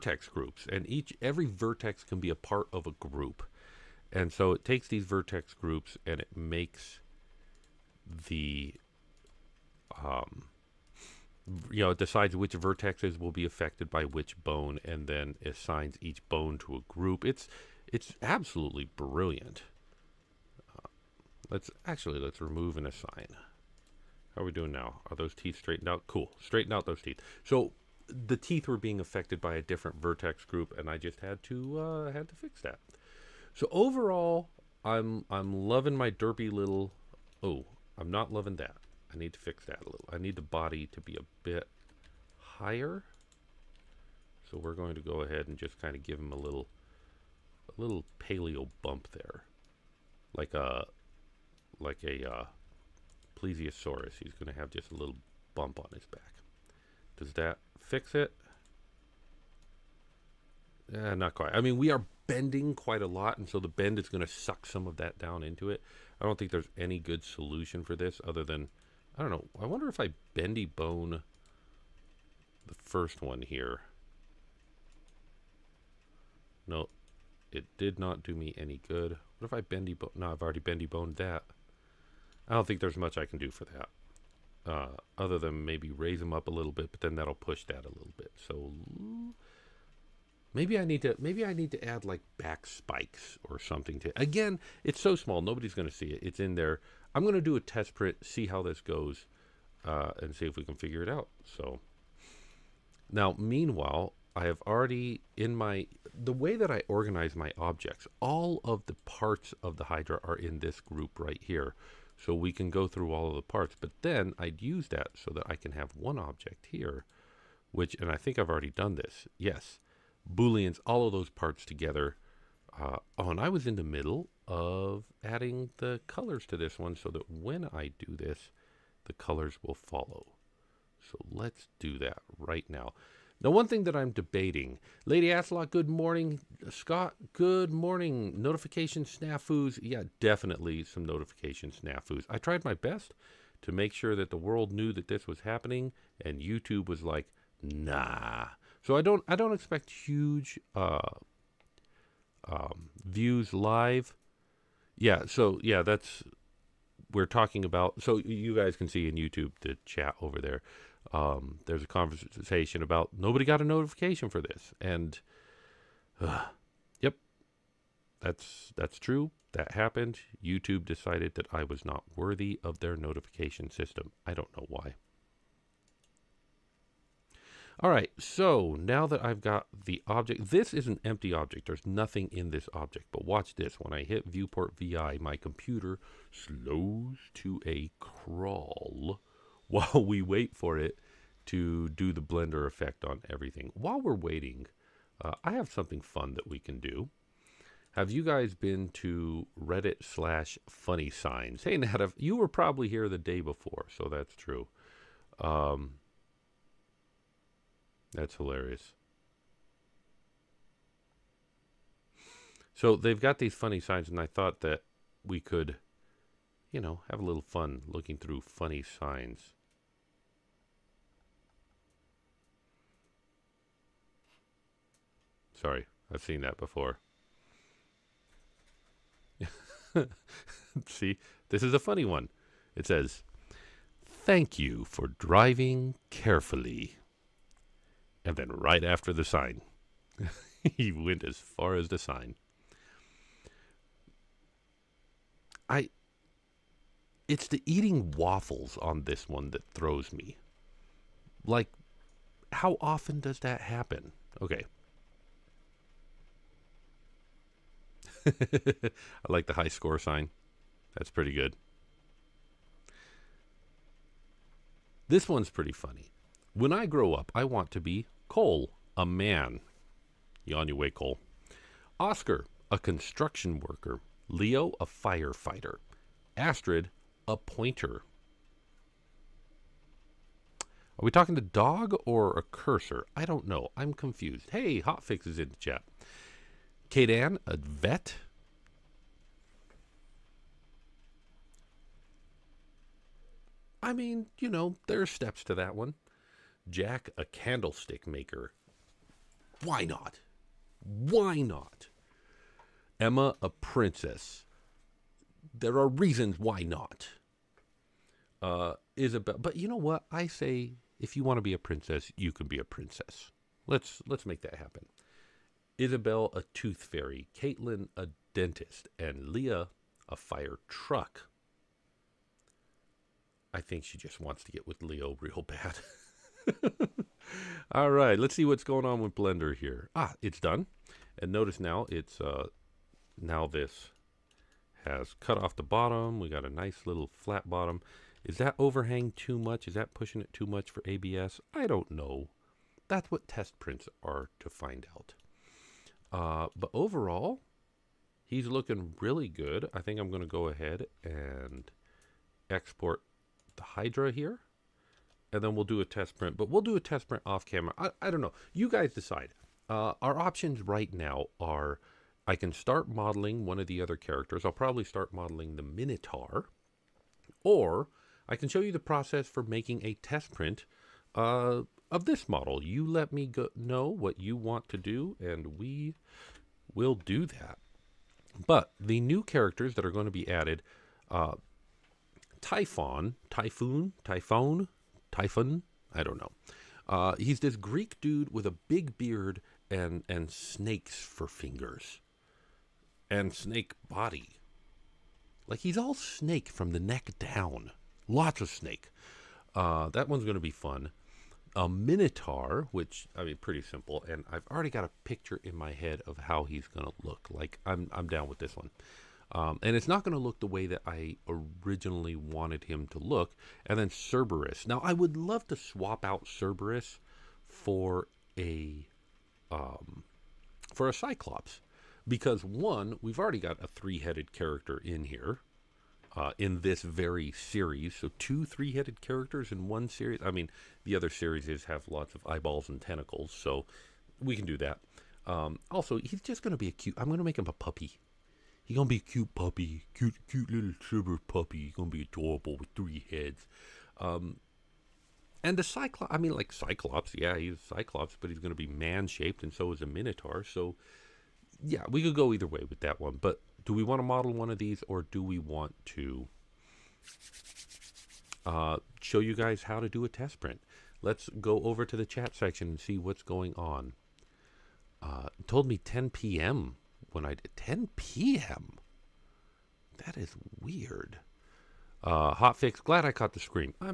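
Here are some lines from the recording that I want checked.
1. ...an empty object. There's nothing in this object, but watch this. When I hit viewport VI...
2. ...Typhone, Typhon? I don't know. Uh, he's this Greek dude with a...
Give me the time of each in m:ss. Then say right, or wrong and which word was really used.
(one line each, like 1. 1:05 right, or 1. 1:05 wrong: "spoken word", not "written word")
1. 3:00 right
2. 6:24 right.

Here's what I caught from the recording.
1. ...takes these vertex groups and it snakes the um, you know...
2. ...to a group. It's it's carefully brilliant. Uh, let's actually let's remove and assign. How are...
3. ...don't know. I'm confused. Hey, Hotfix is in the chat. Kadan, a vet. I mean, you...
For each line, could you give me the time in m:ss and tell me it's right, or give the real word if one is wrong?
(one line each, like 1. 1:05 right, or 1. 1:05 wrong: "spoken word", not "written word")
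1. 0:04 wrong: "makes", not "snakes"
2. 0:16 wrong: "absolutely", not "carefully"
3. 4:43 right.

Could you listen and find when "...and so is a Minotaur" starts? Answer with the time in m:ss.
7:29.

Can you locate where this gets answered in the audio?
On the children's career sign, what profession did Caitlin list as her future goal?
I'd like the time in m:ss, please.
5:17.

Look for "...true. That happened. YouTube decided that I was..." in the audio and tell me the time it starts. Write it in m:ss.
2:48.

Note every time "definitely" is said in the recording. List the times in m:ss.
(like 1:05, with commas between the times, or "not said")
2:20.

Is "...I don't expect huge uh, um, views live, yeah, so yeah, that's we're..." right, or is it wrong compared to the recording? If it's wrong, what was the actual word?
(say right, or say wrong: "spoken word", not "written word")
right.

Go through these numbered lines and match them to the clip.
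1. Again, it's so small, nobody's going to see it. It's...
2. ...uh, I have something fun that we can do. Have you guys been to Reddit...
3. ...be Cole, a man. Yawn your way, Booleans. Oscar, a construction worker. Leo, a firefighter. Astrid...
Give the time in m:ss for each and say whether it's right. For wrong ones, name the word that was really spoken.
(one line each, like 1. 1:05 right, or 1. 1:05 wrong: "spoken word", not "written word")
1. 1:34 right
2. 3:15 right
3. 4:27 wrong: "Cole", not "Booleans".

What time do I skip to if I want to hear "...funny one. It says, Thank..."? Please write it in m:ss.
3:51.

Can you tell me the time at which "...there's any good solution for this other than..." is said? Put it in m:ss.
1:06.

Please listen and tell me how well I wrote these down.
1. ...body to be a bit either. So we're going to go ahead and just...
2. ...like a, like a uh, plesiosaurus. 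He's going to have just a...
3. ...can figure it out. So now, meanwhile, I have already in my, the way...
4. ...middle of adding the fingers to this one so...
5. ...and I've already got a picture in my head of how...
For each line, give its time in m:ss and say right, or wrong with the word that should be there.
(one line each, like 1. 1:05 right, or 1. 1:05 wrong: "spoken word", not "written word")
1. 0:40 wrong: "higher", not "either"
2. 0:50 right
3. 1:40 right
4. 2:03 wrong: "colors", not "fingers"
5. 6:44 right.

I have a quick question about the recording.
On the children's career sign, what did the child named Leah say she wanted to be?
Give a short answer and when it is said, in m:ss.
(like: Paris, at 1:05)
A fire truck, at 5:20.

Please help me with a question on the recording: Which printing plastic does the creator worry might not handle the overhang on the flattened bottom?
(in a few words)
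ABS.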